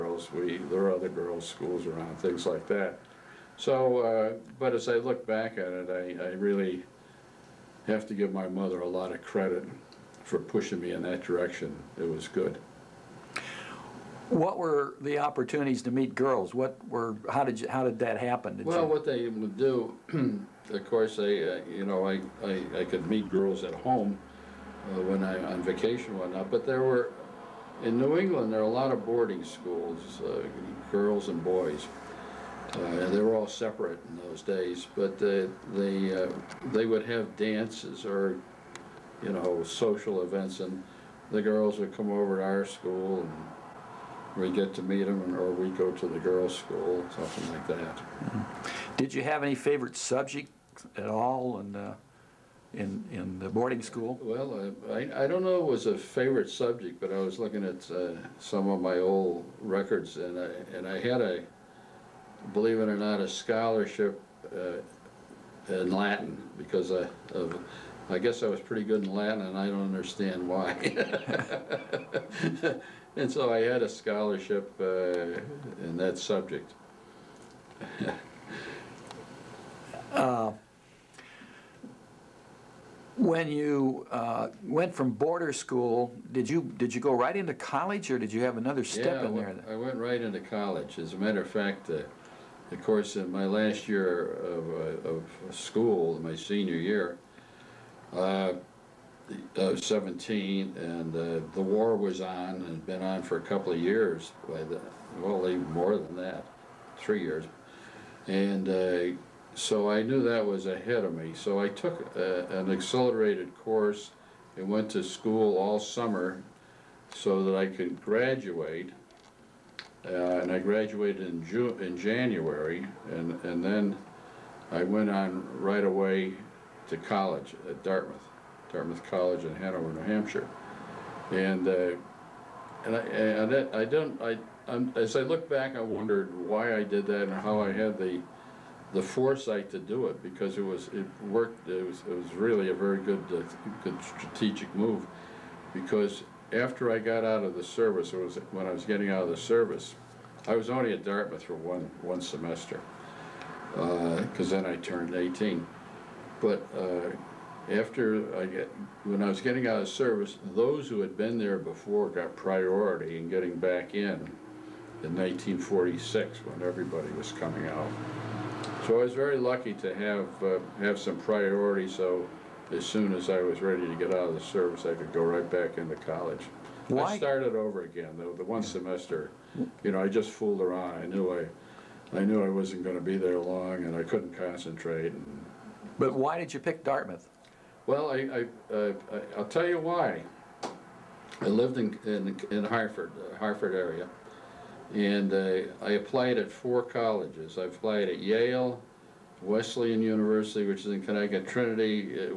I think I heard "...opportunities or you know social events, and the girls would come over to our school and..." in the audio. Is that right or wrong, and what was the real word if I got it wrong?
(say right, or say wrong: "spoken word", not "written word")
wrong: "dances", not "opportunities".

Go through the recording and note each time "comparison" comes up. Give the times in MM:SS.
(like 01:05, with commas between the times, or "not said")
not said.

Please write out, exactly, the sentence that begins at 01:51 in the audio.
So I took a, uh, an accelerated course and went to school all summer so that I could graduate.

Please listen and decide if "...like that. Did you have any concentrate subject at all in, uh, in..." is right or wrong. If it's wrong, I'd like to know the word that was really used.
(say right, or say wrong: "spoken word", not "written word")
wrong: "favorite", not "concentrate".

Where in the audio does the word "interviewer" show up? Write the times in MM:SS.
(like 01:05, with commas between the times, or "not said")
not said.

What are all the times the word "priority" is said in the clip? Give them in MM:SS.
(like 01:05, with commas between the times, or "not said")
02:42, 02:51.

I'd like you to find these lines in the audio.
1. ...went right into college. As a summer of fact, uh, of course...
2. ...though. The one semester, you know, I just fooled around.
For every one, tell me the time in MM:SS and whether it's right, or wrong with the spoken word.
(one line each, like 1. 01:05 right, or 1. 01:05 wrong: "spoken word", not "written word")
1. 01:29 wrong: "matter", not "summer"
2. 02:58 right.